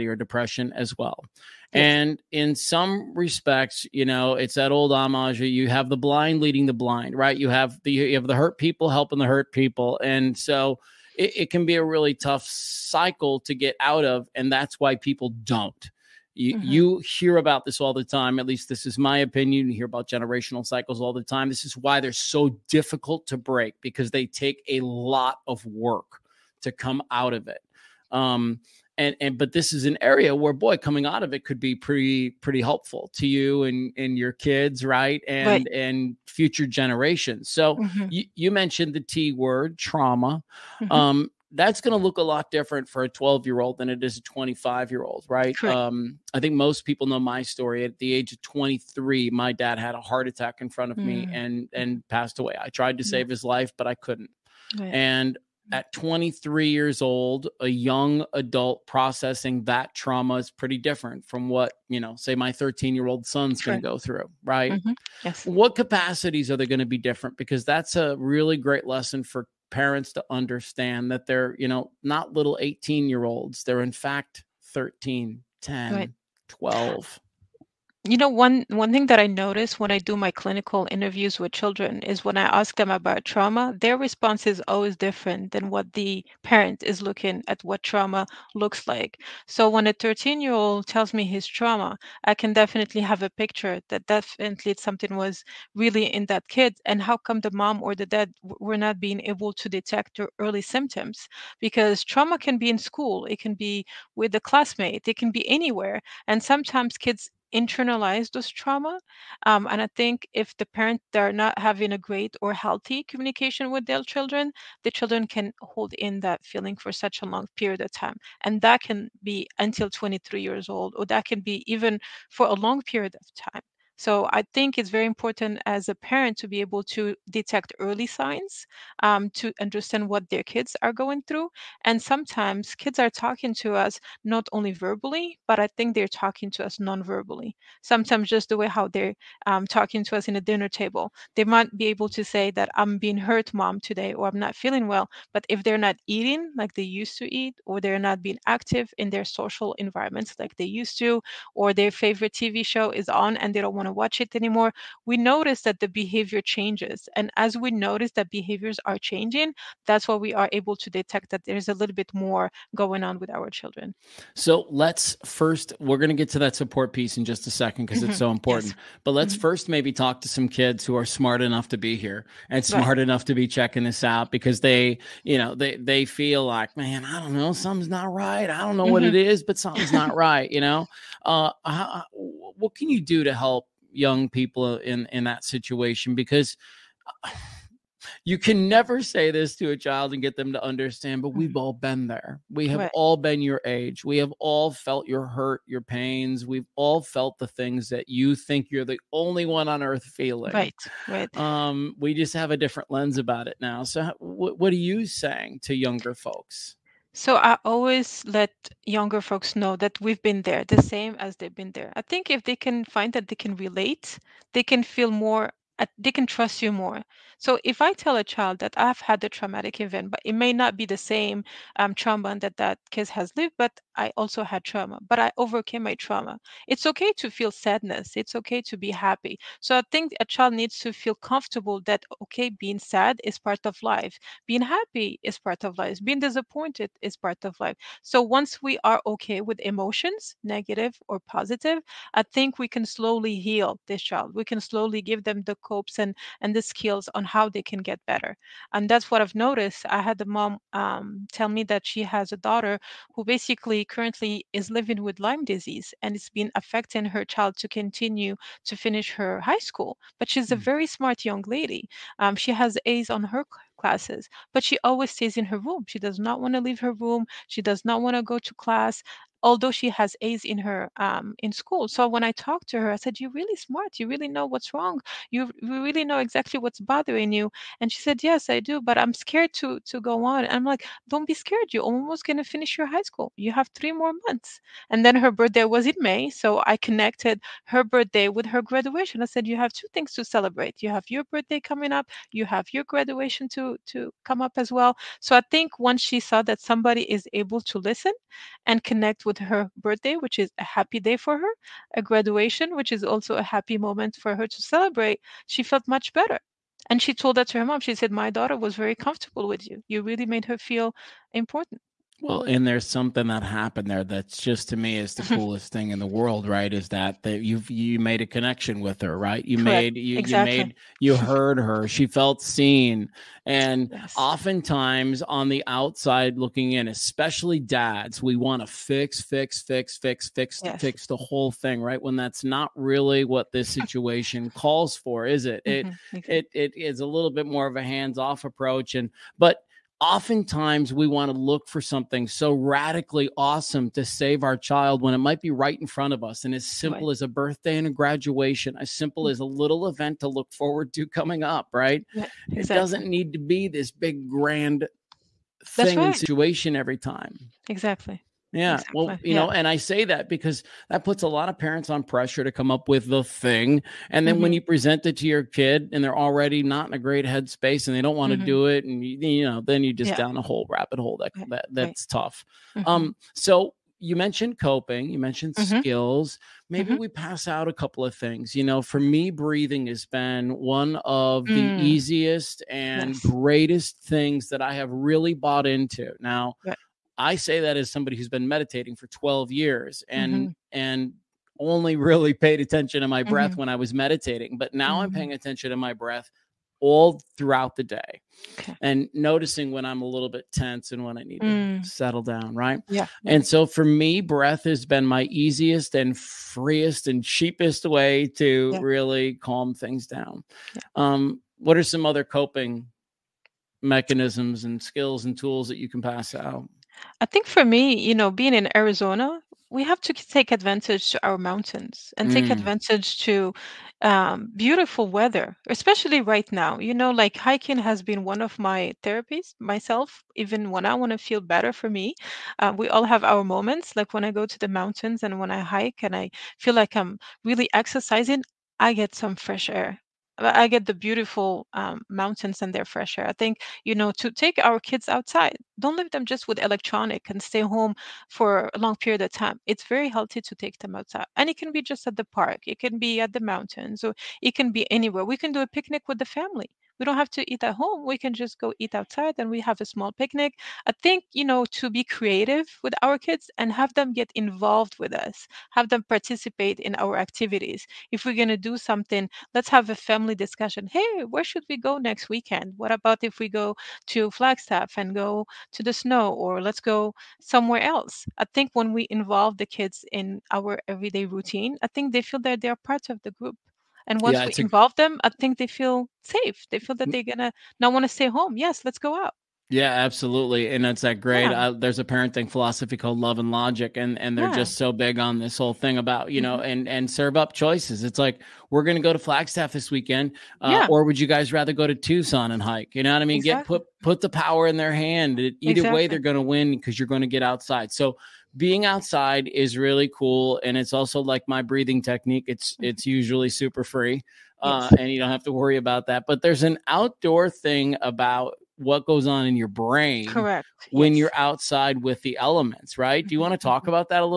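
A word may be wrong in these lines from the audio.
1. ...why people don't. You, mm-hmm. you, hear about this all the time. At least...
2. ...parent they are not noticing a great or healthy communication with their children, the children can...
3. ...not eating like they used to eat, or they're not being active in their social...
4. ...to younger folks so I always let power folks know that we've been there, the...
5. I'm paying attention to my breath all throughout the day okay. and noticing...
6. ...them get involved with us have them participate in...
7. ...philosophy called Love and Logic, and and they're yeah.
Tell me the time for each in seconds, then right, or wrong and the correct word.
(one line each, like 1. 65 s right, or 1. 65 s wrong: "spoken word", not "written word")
1. 14 s right
2. 110 s wrong: "having", not "noticing"
3. 145 s right
4. 205 s wrong: "younger", not "power"
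5. 395 s right
6. 463 s right
7. 492 s right.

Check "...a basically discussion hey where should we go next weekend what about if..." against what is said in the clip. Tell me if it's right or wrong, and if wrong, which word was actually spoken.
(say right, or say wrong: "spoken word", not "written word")
wrong: "family", not "basically".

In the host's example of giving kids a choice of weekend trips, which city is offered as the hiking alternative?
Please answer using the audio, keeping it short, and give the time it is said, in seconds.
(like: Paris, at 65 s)
Tucson, at 501 s.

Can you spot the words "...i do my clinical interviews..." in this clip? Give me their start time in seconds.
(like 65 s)
79 s.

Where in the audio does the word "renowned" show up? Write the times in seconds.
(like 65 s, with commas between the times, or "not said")
not said.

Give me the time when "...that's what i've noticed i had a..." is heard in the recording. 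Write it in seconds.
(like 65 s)
248 s.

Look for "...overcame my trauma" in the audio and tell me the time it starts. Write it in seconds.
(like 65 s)
225 s.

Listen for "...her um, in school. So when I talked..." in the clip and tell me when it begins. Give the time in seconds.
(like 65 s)
270 s.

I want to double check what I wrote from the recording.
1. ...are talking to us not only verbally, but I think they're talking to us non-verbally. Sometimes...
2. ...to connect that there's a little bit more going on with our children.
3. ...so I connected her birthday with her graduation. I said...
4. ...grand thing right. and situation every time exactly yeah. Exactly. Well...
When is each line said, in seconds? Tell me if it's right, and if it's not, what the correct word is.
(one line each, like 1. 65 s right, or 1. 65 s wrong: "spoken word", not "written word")
1. 132 s right
2. 160 s wrong: "detect", not "connect"
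3. 286 s right
4. 354 s right.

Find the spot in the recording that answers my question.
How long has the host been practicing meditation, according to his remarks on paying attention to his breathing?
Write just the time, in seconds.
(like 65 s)
389 s.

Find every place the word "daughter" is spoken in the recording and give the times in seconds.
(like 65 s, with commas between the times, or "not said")
252 s, 308 s.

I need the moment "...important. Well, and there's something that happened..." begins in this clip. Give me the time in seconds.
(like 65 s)
311 s.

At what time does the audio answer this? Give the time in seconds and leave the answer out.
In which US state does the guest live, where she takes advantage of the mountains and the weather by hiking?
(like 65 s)
418 s.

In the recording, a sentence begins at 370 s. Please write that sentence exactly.
down a whole rabbit hole that, that that's right.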